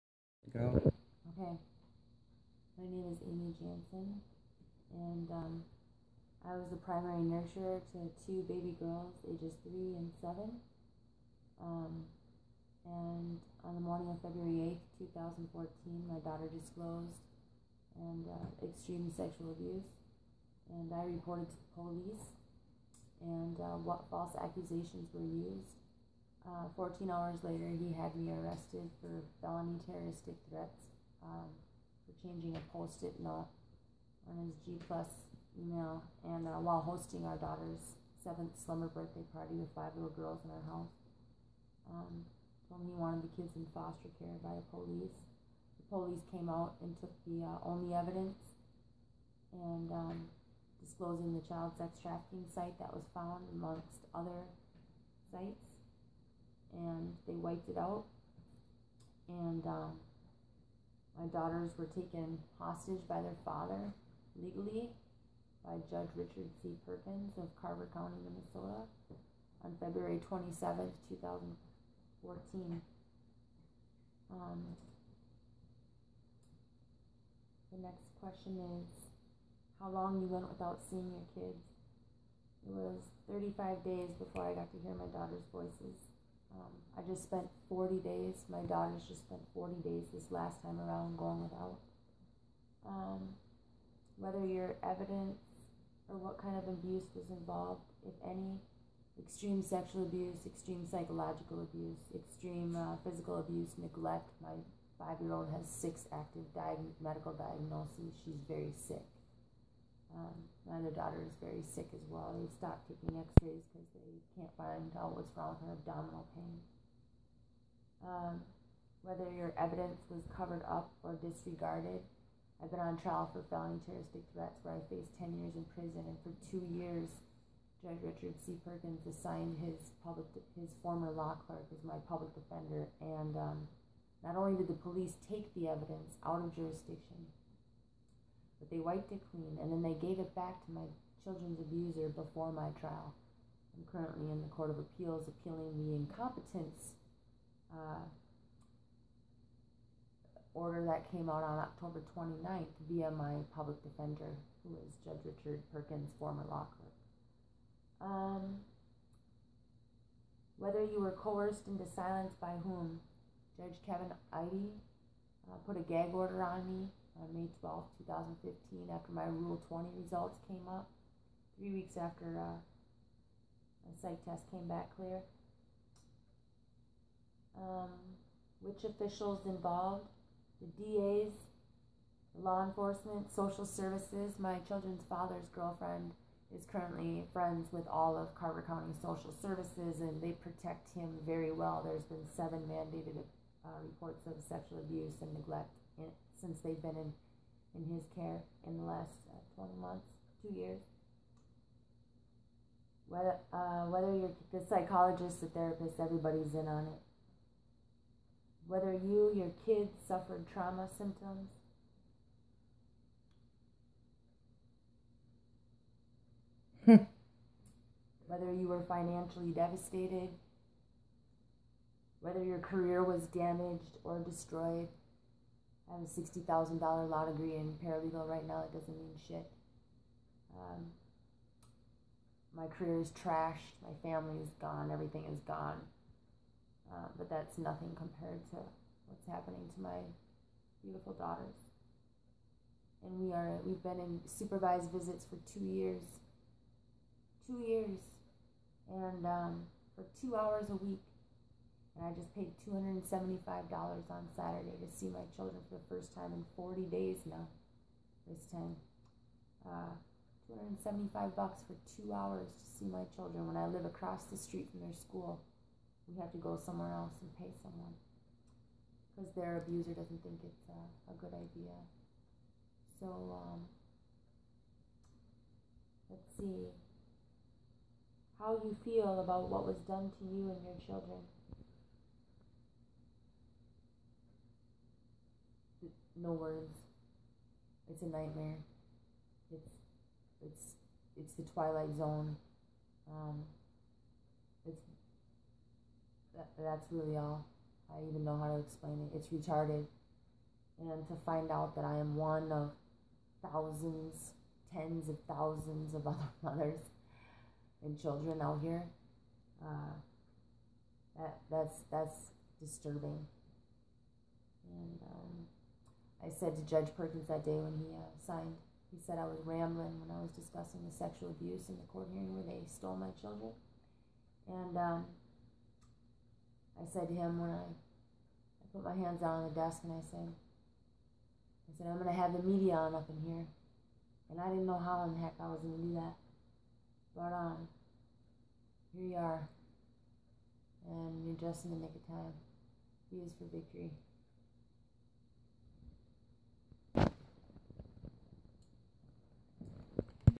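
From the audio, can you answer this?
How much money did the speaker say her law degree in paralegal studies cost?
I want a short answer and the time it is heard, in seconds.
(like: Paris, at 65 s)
$60,000, at 226 s.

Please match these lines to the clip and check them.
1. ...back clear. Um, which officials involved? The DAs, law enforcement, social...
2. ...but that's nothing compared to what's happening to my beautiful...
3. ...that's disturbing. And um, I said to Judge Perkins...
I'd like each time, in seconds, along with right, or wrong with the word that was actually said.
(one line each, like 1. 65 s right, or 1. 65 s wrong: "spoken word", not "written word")
1. 174 s right
2. 237 s right
3. 311 s right.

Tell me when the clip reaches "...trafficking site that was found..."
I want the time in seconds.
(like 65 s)
52 s.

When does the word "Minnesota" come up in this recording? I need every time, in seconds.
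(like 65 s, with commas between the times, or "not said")
68 s.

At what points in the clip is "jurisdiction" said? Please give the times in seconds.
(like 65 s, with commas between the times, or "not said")
136 s.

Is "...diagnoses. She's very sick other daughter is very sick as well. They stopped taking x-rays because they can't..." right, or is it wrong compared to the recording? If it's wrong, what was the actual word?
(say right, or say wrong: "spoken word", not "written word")
right.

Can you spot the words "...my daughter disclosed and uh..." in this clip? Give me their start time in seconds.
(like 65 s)
16 s.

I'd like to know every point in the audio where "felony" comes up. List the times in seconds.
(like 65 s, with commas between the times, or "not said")
29 s, 123 s.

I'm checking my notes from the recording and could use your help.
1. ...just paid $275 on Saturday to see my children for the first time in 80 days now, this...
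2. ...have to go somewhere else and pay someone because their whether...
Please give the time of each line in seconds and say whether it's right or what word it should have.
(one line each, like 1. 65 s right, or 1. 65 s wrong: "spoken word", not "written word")
1. 252 s wrong: "40", not "80"
2. 266 s wrong: "abuser", not "whether".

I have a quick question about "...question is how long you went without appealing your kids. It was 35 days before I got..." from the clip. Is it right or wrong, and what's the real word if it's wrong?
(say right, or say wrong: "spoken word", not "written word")
wrong: "seeing", not "appealing".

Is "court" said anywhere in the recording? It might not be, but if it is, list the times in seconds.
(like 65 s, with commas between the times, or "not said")
144 s, 321 s.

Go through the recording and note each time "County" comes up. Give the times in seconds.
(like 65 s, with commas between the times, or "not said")
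67 s, 188 s.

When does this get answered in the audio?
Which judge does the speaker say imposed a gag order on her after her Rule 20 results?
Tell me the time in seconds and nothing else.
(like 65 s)
163 s.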